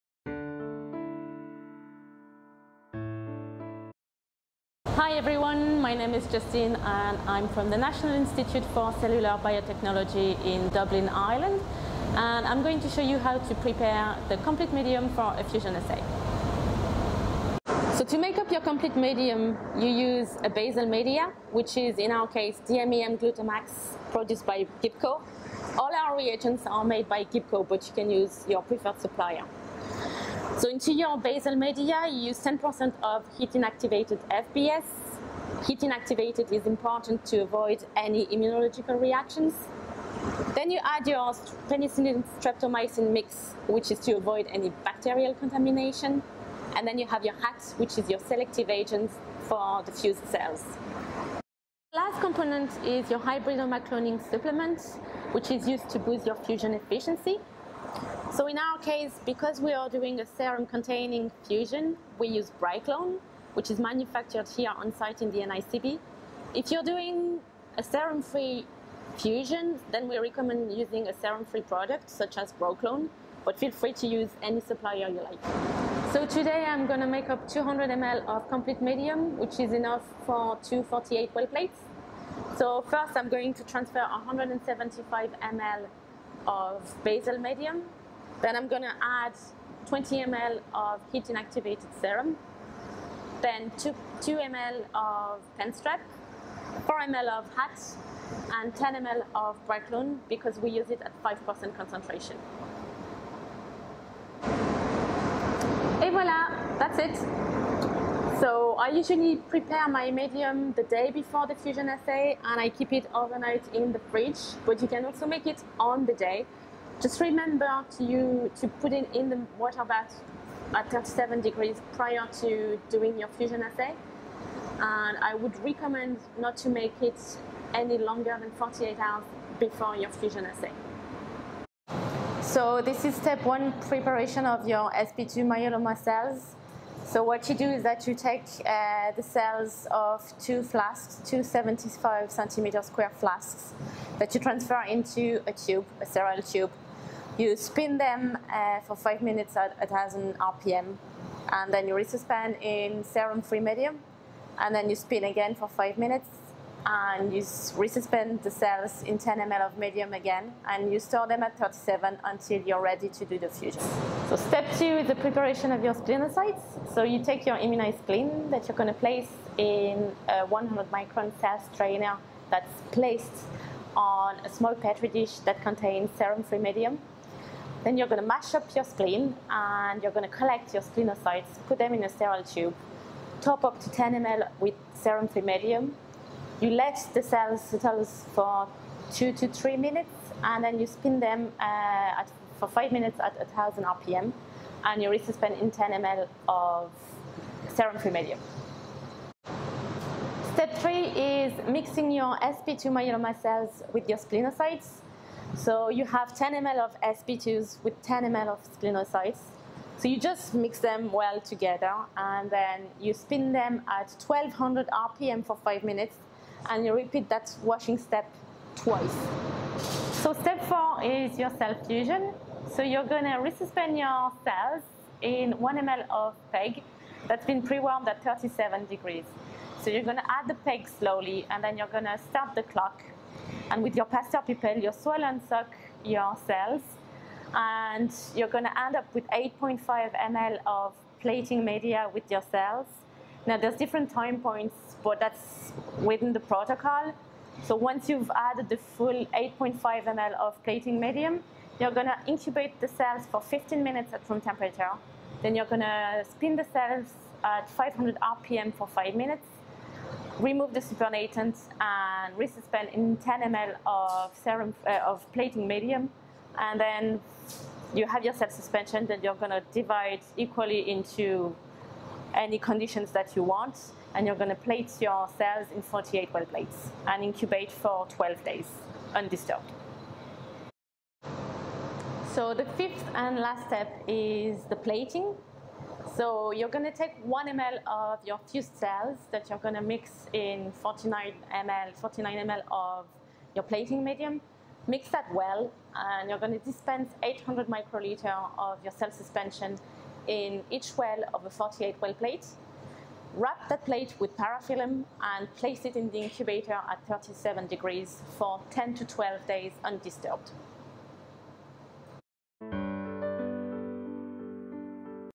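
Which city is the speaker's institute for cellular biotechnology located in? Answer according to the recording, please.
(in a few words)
Dublin.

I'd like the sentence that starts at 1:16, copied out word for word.
So today I'm gonna make up 200 ml of complete medium, which is enough for 248 well plates.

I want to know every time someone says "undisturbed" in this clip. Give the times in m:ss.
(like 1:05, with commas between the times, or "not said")
4:39, 5:09.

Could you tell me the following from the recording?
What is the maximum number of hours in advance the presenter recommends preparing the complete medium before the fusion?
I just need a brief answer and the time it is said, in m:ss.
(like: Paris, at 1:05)
48 hours, at 2:08.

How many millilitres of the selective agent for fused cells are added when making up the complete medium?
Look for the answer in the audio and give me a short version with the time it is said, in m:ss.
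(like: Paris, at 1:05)
4 ml, at 1:36.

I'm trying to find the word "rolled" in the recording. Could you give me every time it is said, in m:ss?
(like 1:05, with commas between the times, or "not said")
not said.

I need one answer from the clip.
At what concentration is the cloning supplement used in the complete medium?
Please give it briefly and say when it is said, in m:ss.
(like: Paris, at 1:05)
5%, at 1:41.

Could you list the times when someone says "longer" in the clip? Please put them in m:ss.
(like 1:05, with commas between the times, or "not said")
2:07.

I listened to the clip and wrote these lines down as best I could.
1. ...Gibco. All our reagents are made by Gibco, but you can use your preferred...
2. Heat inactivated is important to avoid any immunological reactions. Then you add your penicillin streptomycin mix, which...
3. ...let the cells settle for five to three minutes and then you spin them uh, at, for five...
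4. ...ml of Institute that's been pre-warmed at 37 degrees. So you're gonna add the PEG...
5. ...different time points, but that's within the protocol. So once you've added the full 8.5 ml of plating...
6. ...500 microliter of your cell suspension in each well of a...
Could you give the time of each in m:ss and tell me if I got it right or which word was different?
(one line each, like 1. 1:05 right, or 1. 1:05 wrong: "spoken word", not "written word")
1. 0:24 right
2. 0:35 right
3. 3:06 wrong: "two", not "five"
4. 3:45 wrong: "PEG", not "Institute"
5. 4:03 right
6. 4:57 wrong: "800", not "500".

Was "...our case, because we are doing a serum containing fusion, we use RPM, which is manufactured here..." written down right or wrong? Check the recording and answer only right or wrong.
wrong.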